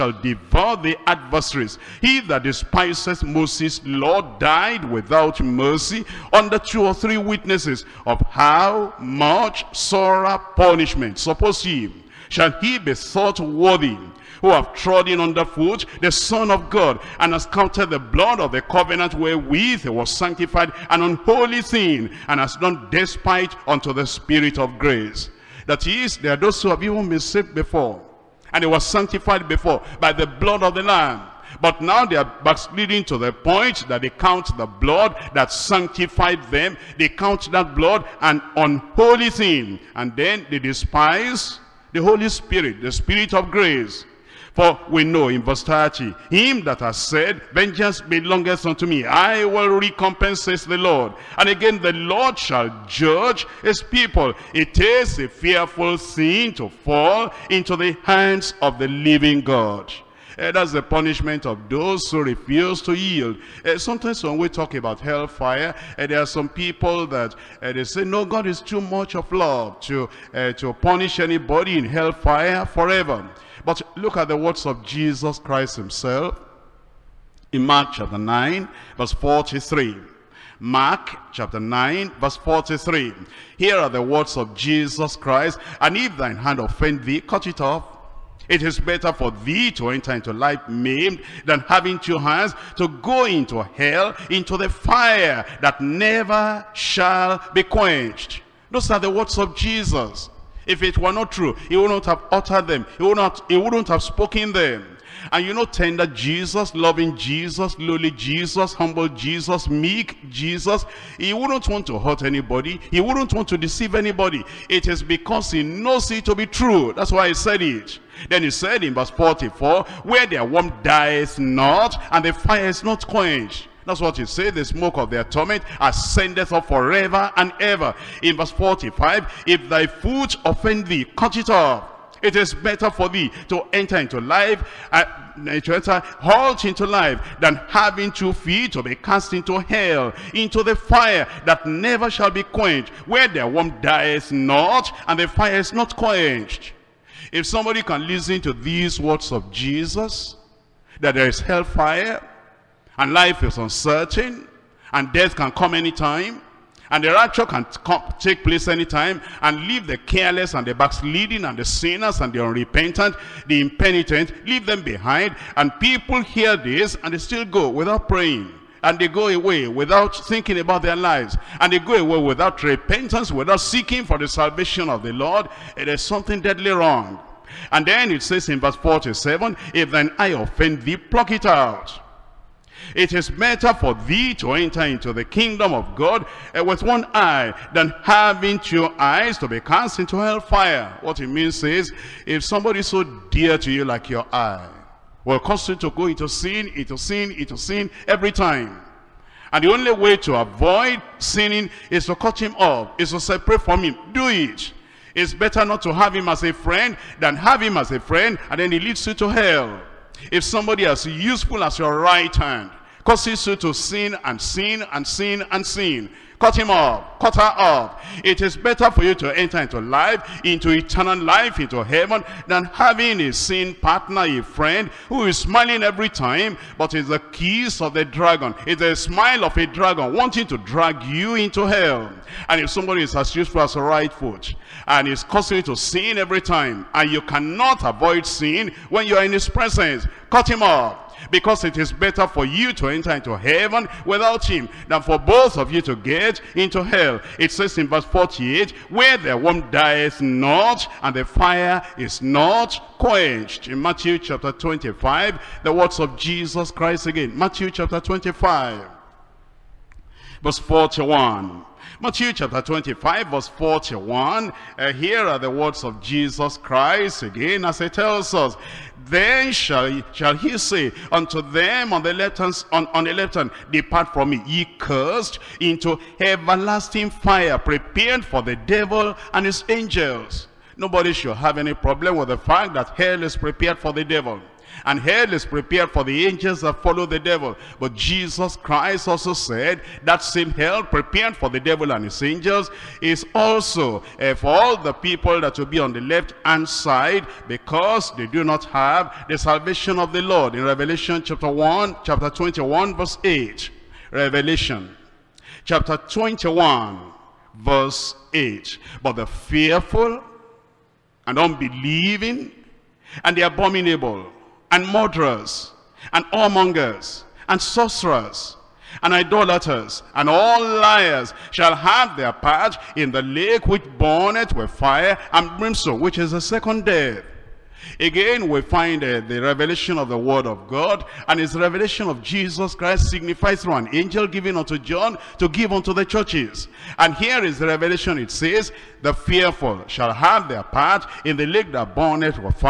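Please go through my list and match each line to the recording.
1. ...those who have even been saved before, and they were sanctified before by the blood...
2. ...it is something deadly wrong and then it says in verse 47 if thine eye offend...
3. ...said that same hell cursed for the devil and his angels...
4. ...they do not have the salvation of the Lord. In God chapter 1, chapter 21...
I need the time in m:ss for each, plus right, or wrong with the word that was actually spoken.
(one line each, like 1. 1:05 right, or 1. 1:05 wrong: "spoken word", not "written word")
1. 0:26 right
2. 2:55 right
3. 4:49 wrong: "prepared", not "cursed"
4. 4:58 wrong: "Revelation", not "God".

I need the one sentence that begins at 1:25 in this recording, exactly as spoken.
And if thine hand offend thee, cut it off.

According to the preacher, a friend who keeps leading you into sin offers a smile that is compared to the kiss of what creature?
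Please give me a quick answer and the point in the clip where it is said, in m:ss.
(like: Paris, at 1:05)
the dragon, at 3:47.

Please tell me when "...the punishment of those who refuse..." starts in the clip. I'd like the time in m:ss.
1:00.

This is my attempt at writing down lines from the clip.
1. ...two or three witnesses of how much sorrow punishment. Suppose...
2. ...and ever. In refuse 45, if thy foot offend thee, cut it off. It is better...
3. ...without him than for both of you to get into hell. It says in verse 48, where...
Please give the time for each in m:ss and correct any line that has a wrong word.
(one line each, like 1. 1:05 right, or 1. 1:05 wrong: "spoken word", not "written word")
1. 0:06 right
2. 2:07 wrong: "verse", not "refuse"
3. 4:04 right.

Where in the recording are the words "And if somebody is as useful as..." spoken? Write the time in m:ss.
3:52.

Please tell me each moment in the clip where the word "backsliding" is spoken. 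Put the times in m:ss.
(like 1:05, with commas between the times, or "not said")
0:32, 2:40.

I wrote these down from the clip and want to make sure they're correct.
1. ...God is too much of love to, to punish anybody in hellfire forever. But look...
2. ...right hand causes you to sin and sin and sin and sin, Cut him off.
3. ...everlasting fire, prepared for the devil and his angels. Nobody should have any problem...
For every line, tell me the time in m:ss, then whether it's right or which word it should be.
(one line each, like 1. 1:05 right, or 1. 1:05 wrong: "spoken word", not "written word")
1. 1:08 right
2. 3:31 right
3. 4:36 right.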